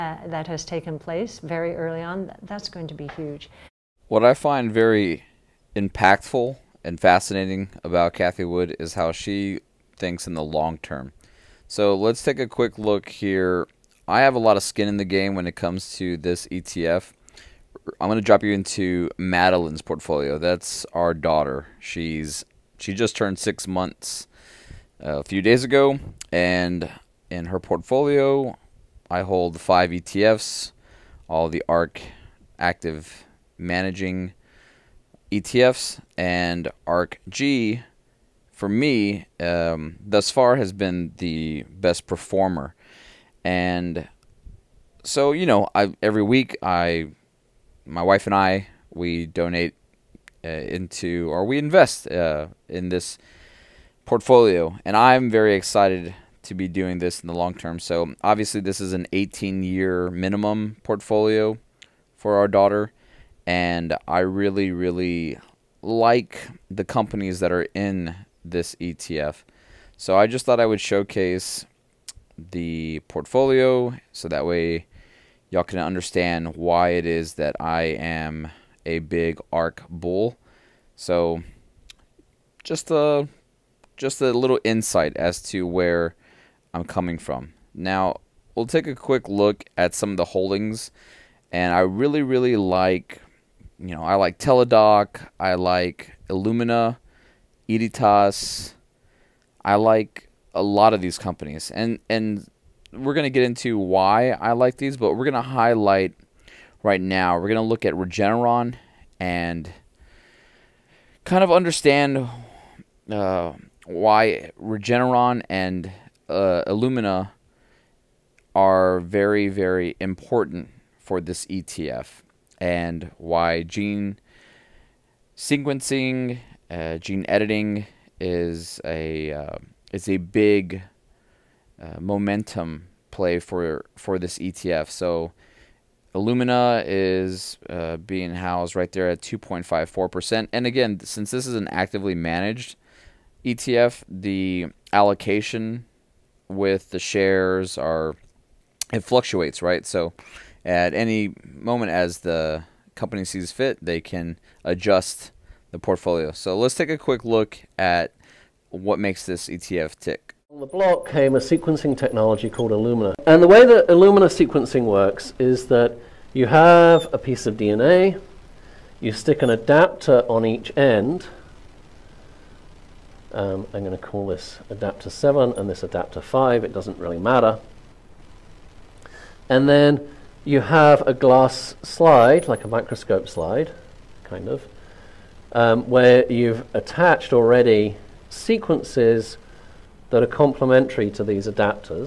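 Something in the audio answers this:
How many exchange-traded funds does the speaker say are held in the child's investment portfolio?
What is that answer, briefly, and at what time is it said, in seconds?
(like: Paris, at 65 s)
5, at 29 s.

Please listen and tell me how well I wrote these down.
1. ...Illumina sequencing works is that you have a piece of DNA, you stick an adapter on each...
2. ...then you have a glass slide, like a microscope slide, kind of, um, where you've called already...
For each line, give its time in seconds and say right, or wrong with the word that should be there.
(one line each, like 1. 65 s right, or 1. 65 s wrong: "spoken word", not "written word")
1. 163 s right
2. 179 s wrong: "attached", not "called".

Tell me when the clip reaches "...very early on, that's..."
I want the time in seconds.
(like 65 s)
1 s.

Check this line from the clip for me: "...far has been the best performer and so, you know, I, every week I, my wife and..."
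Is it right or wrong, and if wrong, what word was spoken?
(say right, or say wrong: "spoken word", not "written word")
right.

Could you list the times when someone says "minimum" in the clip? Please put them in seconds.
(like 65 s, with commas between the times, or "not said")
60 s.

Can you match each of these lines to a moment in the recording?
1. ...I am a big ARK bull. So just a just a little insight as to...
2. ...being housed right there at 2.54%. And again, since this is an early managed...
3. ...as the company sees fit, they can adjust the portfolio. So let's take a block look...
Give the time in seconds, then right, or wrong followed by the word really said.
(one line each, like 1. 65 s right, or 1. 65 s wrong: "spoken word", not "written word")
1. 77 s right
2. 137 s wrong: "actively", not "early"
3. 151 s wrong: "quick", not "block".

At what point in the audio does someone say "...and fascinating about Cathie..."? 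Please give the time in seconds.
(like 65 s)
6 s.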